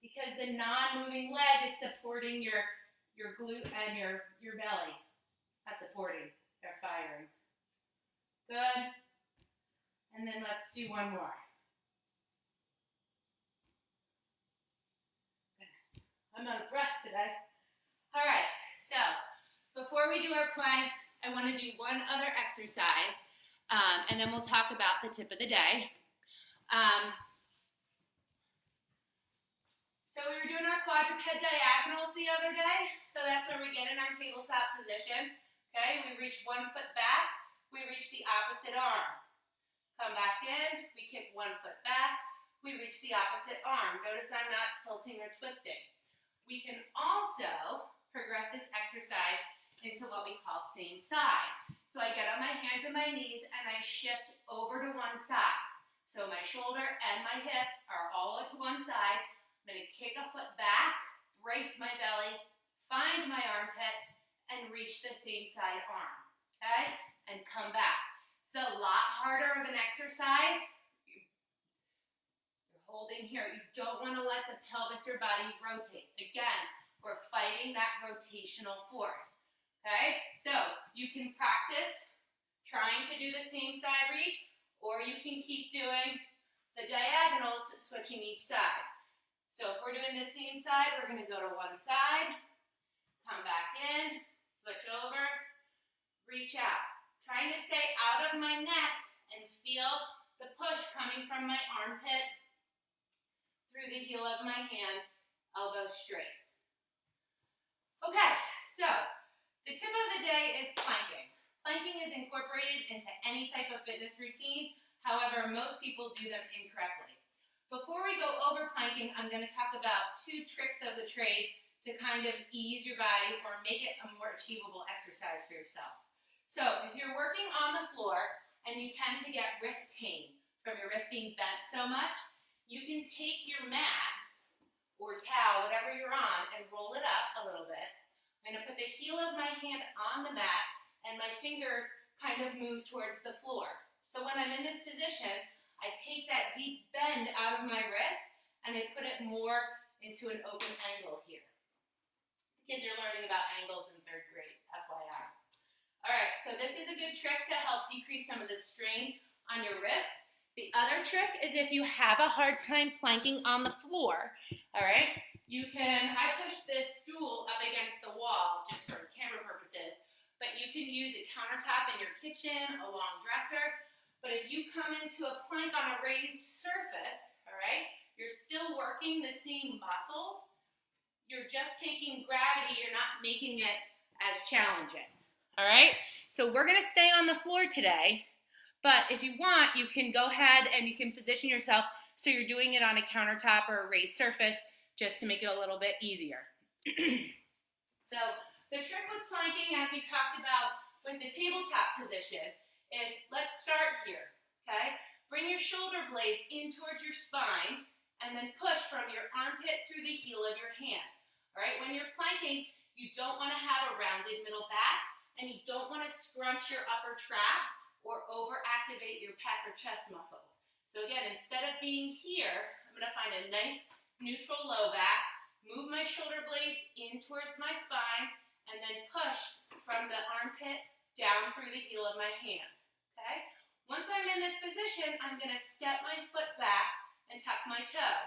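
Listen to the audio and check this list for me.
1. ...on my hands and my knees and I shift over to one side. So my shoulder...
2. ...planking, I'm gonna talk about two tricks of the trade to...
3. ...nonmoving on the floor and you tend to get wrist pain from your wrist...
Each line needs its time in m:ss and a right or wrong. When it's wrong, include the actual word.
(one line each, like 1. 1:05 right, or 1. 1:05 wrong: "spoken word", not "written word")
1. 0:52 right
2. 1:58 right
3. 2:07 wrong: "working", not "nonmoving".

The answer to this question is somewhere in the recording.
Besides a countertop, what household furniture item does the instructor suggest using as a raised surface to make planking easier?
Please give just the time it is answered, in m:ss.
2:52.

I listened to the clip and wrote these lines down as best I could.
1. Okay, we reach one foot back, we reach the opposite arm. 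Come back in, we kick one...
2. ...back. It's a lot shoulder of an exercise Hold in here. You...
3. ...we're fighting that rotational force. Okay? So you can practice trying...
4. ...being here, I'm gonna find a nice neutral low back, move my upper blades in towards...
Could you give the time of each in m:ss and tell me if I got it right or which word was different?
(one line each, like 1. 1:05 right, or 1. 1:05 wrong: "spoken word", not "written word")
1. 0:35 right
2. 1:07 wrong: "harder", not "shoulder"
3. 1:17 right
4. 3:41 wrong: "shoulder", not "upper".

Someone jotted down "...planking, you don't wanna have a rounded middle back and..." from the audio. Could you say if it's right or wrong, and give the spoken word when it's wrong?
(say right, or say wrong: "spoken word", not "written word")
right.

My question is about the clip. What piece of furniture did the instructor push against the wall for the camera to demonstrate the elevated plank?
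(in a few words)
stool.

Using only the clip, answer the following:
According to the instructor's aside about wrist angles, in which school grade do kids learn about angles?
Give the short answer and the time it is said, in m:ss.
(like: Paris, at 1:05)
third grade, at 2:34.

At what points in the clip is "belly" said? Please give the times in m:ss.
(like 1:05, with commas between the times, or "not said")
0:04, 1:01.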